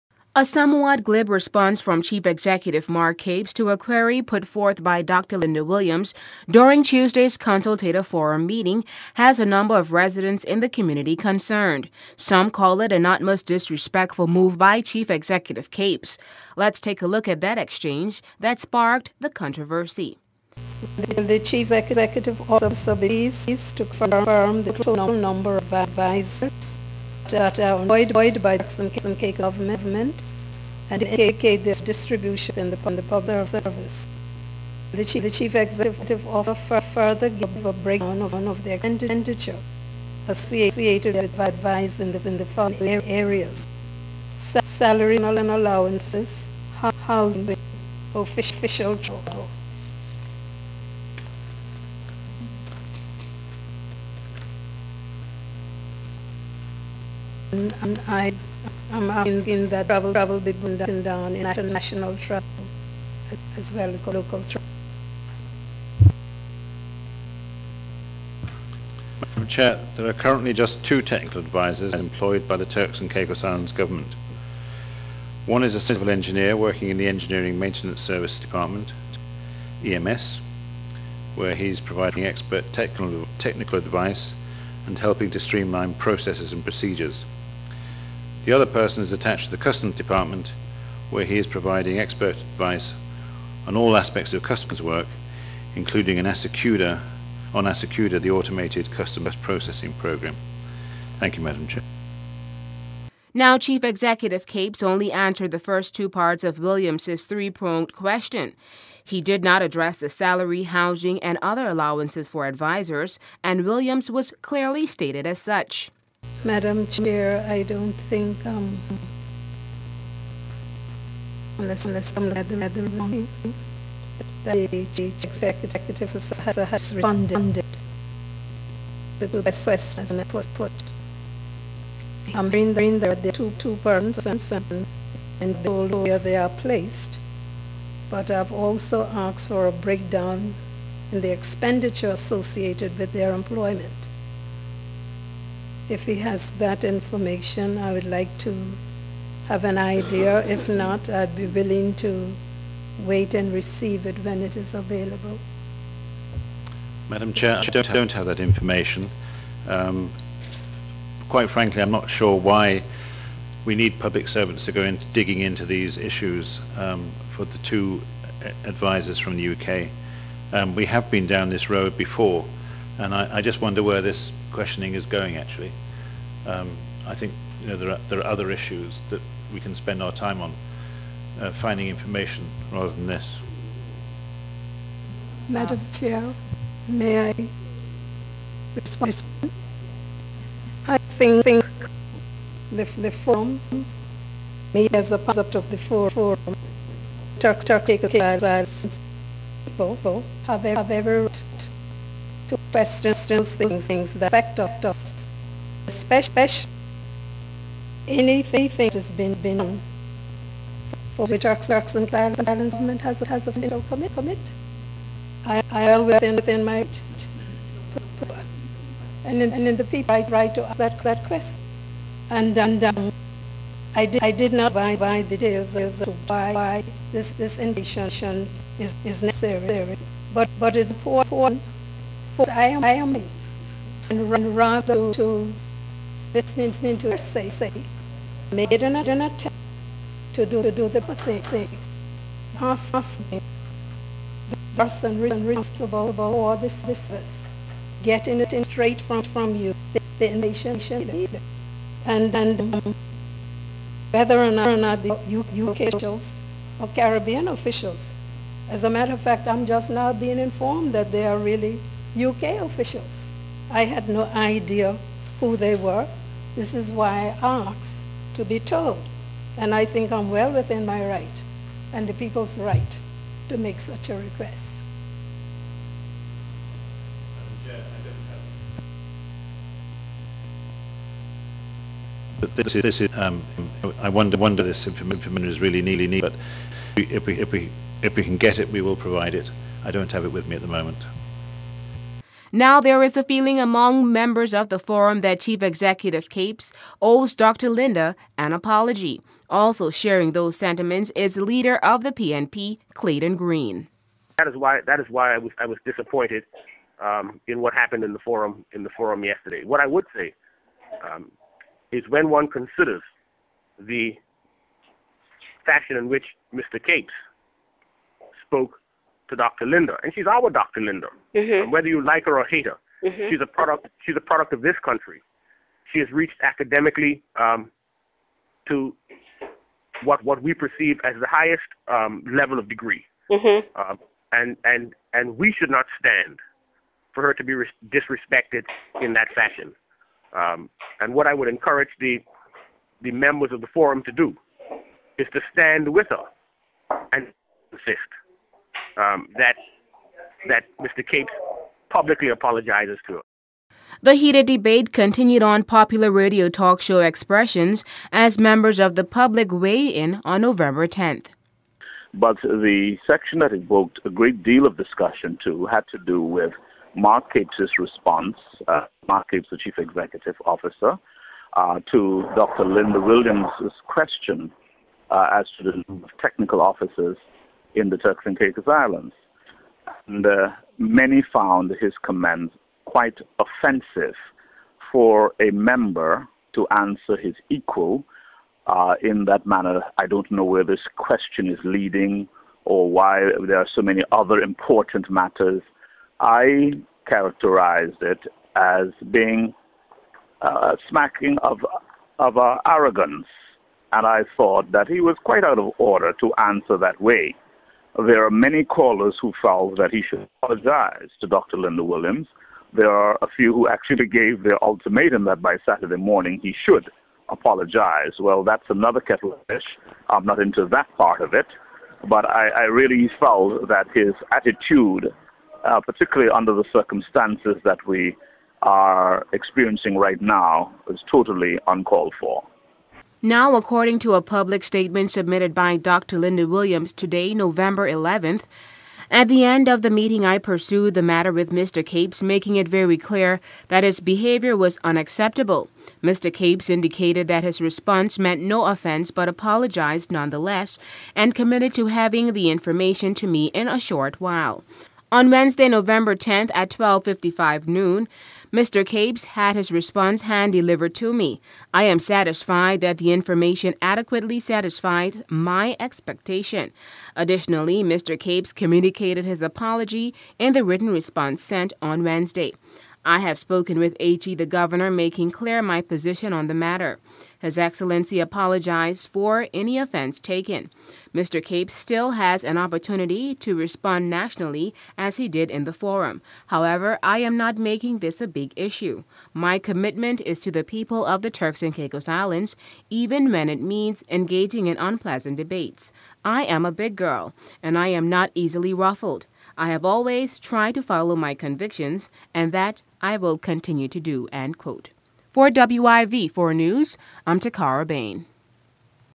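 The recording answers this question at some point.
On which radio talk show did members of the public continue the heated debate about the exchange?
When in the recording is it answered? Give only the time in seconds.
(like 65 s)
356 s.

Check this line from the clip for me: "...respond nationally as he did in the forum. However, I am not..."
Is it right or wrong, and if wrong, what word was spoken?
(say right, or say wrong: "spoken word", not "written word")
right.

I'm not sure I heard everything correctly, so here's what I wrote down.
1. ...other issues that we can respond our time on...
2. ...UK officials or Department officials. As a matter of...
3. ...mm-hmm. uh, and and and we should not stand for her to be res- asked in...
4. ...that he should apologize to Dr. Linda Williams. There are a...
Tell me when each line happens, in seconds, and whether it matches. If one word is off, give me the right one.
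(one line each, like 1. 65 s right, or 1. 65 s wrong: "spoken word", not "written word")
1. 178 s wrong: "spend", not "respond"
2. 255 s wrong: "Caribbean", not "Department"
3. 333 s wrong: "disrespected", not "asked"
4. 409 s right.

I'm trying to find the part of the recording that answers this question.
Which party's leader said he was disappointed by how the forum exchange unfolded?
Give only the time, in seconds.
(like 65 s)
302 s.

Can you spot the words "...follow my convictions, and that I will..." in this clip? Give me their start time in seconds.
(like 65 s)
500 s.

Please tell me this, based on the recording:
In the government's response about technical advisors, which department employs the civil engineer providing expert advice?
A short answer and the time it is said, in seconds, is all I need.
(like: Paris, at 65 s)
Engineering Maintenance Service Department, at 77 s.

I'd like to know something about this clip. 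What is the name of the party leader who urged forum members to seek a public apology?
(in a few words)
Clayton Green.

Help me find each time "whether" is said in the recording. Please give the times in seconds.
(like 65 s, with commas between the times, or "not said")
254 s, 321 s.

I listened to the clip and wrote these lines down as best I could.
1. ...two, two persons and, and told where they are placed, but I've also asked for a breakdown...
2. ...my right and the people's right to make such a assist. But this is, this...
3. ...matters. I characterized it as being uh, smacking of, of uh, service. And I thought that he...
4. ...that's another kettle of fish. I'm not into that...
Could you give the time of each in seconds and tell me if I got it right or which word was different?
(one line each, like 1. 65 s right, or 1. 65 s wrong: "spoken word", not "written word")
1. 133 s right
2. 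270 s wrong: "request", not "assist"
3. 395 s wrong: "arrogance", not "service"
4. 418 s right.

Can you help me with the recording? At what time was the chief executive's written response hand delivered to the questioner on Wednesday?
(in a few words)
12:55.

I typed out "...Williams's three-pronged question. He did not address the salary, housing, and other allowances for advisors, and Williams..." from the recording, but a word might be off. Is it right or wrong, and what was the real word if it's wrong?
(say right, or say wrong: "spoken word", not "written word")
right.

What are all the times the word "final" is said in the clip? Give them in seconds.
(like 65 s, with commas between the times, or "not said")
213 s.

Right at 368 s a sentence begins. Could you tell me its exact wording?
Uh, Mark Capes, the chief executive officer, uh, to Dr.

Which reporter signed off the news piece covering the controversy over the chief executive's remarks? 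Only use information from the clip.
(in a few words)
Takara Bain.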